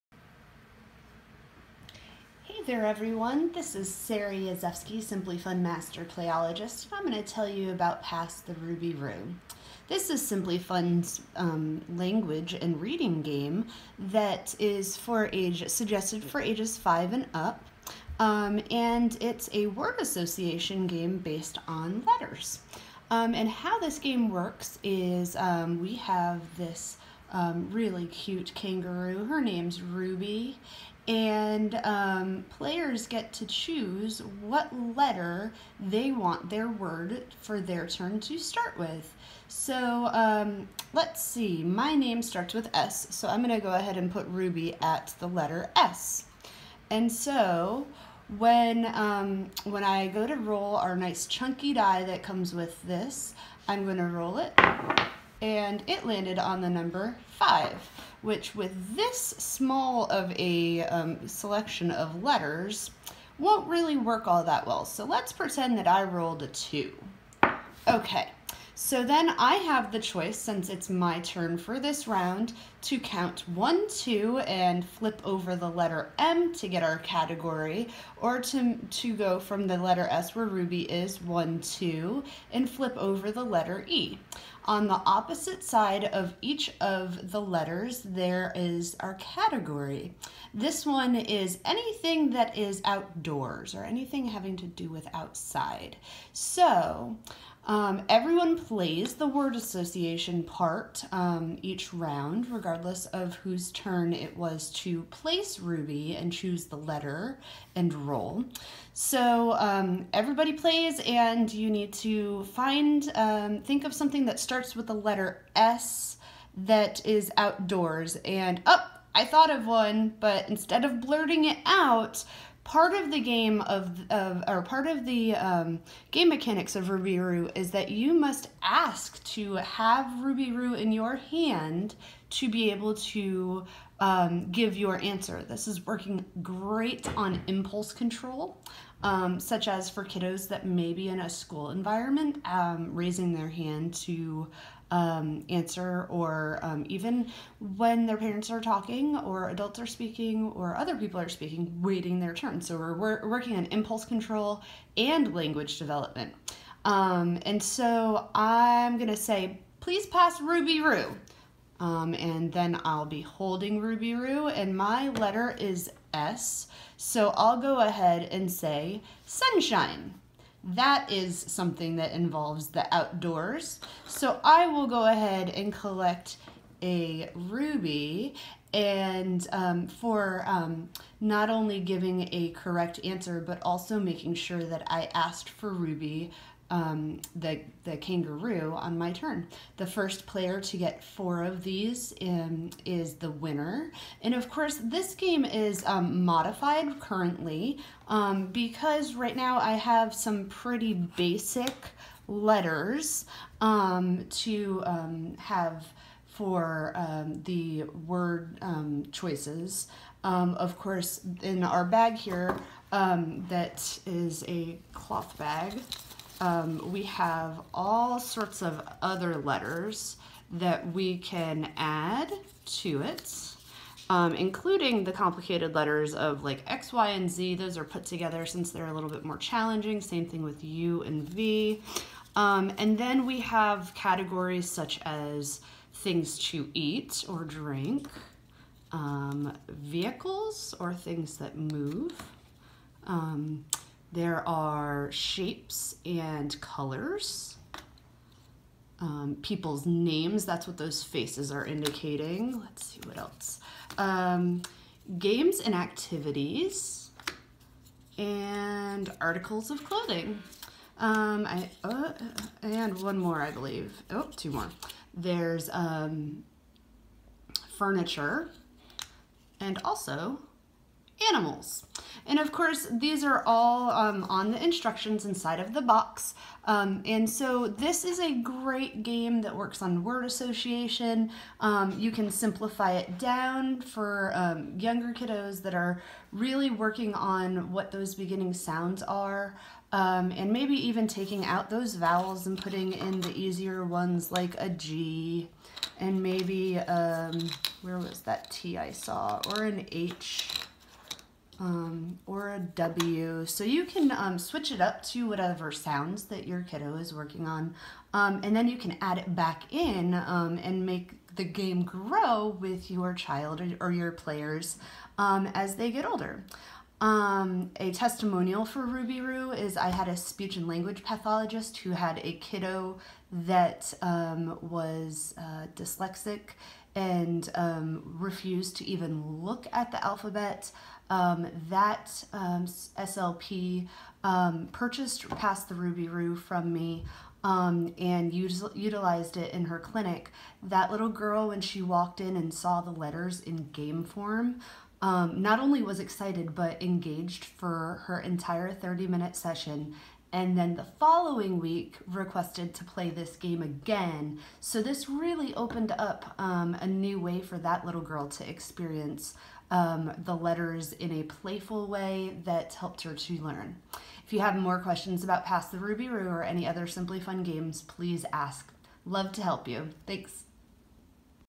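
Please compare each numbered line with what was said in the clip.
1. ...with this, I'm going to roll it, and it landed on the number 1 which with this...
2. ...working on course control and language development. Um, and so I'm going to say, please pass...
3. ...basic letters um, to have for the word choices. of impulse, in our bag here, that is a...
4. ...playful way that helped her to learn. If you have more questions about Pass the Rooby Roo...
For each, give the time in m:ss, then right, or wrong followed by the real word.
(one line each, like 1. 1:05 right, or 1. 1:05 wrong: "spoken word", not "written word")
1. 0:52 wrong: "5", not "1"
2. 2:33 wrong: "impulse", not "course"
3. 3:20 wrong: "course", not "impulse"
4. 6:01 right.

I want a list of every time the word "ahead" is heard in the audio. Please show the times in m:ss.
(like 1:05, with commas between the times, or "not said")
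0:43, 2:47, 2:55.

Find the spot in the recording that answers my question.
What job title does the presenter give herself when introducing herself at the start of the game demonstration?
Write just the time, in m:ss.
0:05.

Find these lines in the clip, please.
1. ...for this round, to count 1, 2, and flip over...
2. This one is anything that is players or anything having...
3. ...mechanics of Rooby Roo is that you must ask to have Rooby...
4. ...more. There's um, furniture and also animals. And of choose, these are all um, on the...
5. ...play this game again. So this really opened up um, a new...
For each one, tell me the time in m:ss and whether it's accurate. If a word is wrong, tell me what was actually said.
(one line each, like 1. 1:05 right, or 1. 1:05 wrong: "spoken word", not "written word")
1. 1:11 right
2. 1:30 wrong: "outdoors", not "players"
3. 2:06 right
4. 4:24 wrong: "course", not "choose"
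5. 5:52 right.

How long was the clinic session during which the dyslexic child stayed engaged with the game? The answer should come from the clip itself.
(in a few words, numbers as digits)
30 minutes.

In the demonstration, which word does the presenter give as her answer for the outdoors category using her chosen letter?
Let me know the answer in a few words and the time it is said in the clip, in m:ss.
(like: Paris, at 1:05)
sunshine, at 2:49.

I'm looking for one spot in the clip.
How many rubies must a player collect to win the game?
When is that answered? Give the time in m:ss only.
3:11.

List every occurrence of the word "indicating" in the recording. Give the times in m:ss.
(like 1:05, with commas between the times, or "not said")
4:11.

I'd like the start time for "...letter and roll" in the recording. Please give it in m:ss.
1:46.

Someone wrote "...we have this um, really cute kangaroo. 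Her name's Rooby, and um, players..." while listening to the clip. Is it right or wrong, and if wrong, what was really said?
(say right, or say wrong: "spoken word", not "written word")
right.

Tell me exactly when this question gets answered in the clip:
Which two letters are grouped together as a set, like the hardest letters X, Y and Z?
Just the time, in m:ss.
3:50.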